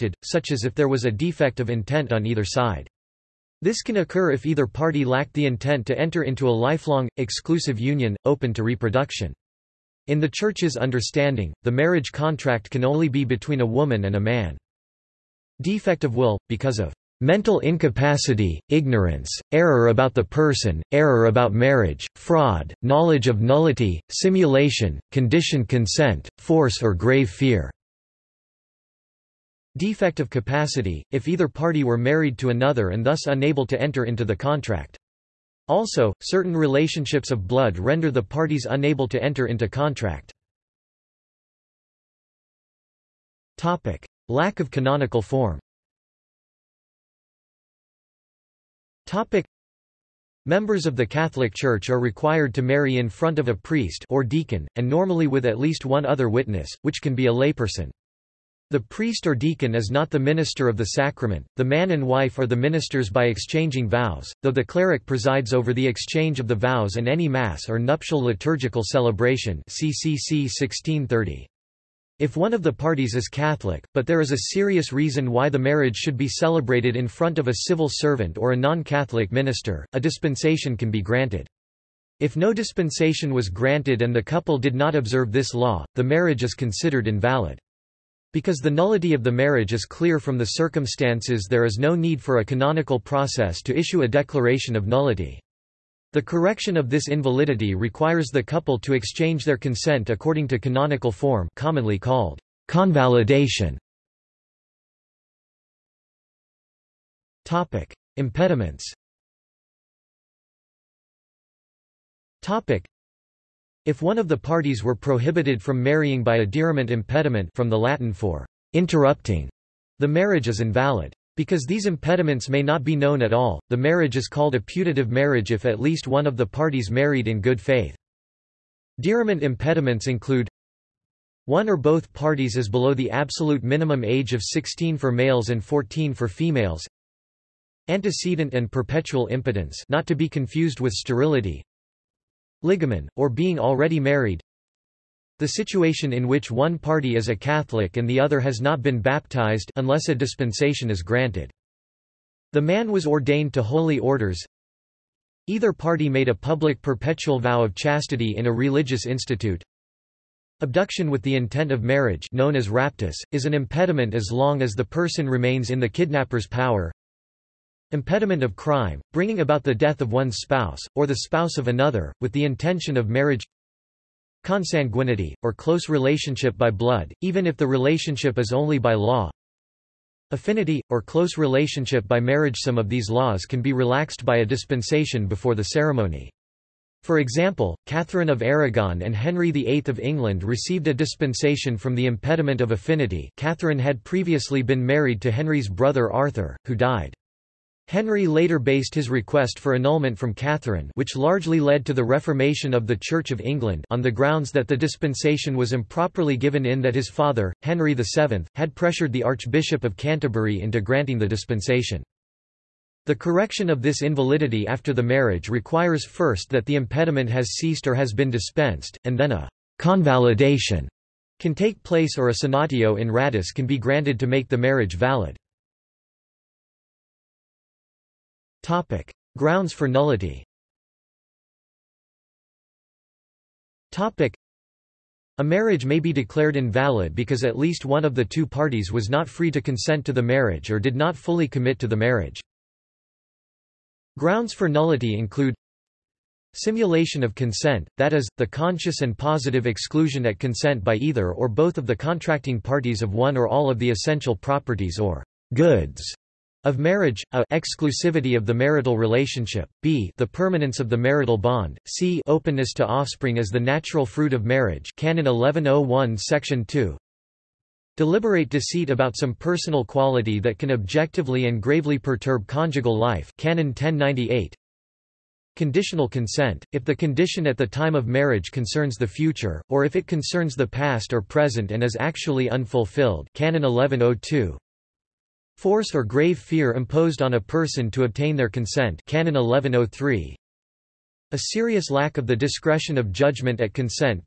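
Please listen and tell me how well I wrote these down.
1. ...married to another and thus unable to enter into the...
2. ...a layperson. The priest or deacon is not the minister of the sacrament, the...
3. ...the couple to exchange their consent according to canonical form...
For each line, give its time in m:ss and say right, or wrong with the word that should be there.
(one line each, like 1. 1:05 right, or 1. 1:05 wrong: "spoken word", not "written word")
1. 0:31 right
2. 0:57 right
3. 1:38 right.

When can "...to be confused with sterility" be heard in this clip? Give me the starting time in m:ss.
2:20.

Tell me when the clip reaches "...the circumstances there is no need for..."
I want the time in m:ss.
1:30.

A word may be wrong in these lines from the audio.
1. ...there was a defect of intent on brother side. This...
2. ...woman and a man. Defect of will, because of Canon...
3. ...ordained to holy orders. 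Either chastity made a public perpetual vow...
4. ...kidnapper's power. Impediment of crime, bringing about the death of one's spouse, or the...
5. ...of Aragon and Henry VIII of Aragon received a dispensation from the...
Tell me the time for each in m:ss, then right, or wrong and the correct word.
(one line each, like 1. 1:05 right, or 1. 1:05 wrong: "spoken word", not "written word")
1. 0:00 wrong: "either", not "brother"
2. 0:13 wrong: "Mental", not "Canon"
3. 2:33 wrong: "party", not "chastity"
4. 2:45 right
5. 3:08 wrong: "England", not "Aragon".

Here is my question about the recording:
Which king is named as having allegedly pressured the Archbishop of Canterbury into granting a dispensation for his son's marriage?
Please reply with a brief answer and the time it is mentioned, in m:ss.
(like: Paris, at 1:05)
Henry VII, at 3:27.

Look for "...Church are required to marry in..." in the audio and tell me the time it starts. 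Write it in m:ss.
0:51.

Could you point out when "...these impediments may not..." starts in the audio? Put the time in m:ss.
2:01.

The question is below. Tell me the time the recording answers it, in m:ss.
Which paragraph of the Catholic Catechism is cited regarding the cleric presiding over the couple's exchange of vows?
1:09.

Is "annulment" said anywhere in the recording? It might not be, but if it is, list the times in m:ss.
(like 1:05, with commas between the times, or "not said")
3:19.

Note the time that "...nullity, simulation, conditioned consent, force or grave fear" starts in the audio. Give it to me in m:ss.
0:23.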